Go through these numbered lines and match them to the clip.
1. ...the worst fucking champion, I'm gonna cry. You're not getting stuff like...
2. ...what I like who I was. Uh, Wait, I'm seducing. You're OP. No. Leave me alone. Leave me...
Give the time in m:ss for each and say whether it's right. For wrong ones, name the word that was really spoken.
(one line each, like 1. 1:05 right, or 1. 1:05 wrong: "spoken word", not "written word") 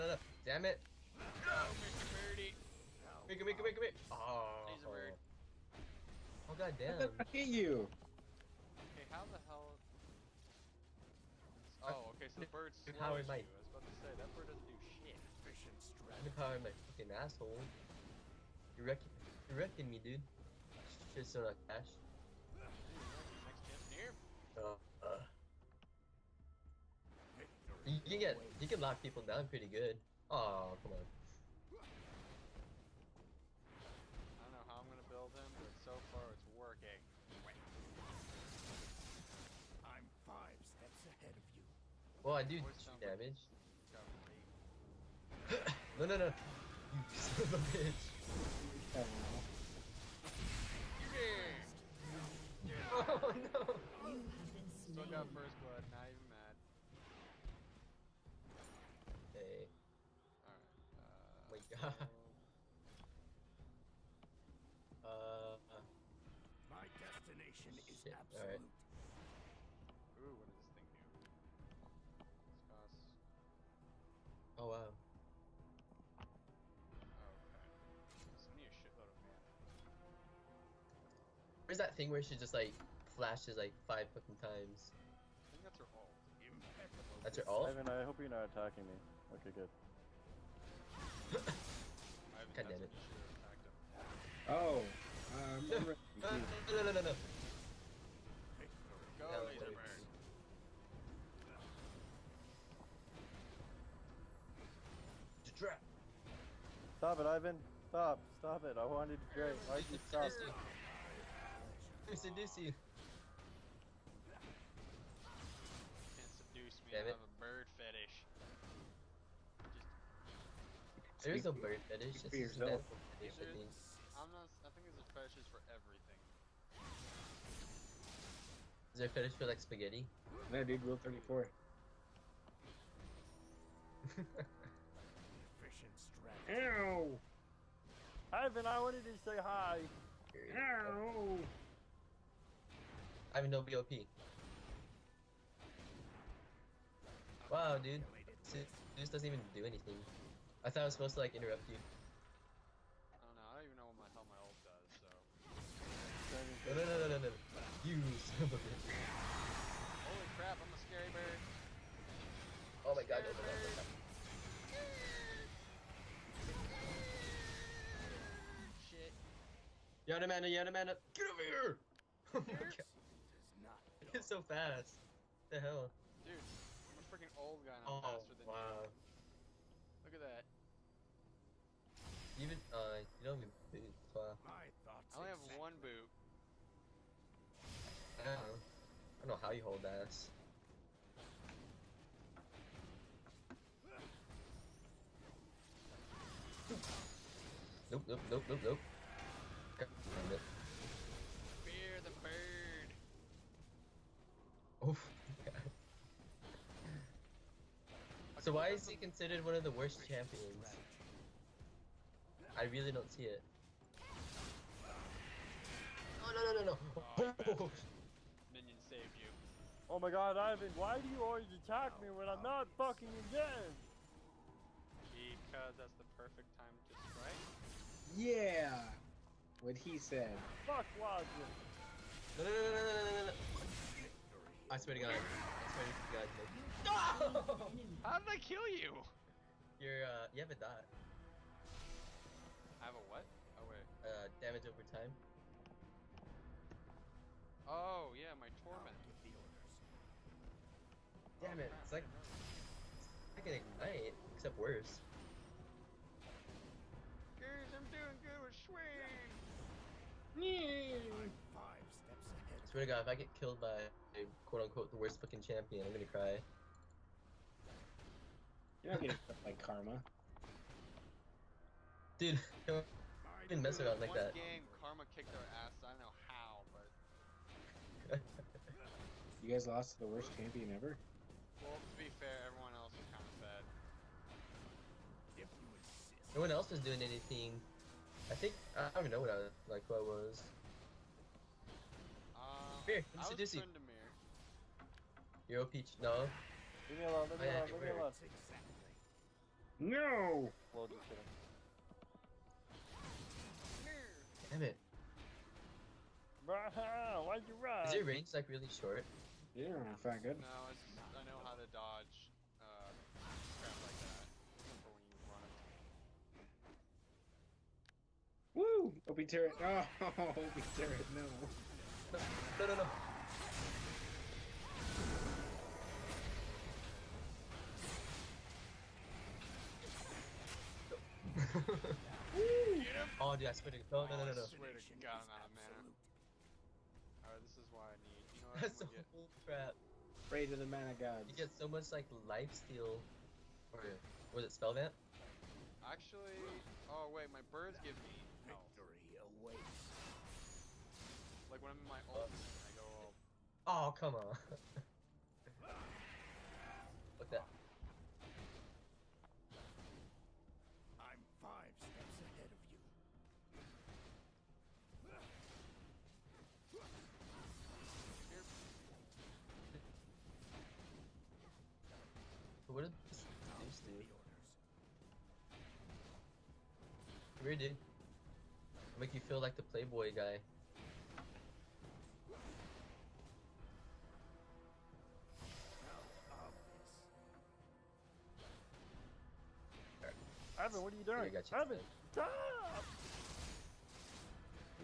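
1. 4:24 right
2. 4:49 wrong: "Here", not "Wait".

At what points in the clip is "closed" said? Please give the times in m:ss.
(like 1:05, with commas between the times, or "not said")
not said.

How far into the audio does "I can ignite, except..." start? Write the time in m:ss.
4:13.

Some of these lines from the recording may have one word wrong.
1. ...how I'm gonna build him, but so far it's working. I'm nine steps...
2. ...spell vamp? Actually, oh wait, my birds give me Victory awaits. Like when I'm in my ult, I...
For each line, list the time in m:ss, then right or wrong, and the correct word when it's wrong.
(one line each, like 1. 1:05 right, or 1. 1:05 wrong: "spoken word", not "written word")
1. 0:34 wrong: "five", not "nine"
2. 5:44 right.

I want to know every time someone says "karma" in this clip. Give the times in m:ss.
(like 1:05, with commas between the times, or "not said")
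4:29, 4:34.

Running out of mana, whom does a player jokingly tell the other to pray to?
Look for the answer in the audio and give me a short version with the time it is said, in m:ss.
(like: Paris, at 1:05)
the mana gods, at 5:40.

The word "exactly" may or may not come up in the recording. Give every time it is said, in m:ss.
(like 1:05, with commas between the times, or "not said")
3:05, 4:58.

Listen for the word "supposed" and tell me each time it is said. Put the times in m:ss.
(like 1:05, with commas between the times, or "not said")
2:30.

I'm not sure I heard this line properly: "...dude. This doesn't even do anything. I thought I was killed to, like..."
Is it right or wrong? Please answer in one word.
wrong.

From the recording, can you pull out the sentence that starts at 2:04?
I think there's a fetish for everything.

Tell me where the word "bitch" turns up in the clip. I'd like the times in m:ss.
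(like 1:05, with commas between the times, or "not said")
0:47, 2:38.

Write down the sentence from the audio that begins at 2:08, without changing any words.
Is there a fetish for like spaghetti?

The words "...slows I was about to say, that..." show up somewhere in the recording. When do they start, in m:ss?
0:12.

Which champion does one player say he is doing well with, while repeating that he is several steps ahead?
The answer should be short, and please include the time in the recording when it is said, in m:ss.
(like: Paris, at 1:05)
Swain, at 4:18.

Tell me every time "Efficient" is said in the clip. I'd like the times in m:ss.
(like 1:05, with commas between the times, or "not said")
0:15, 2:15.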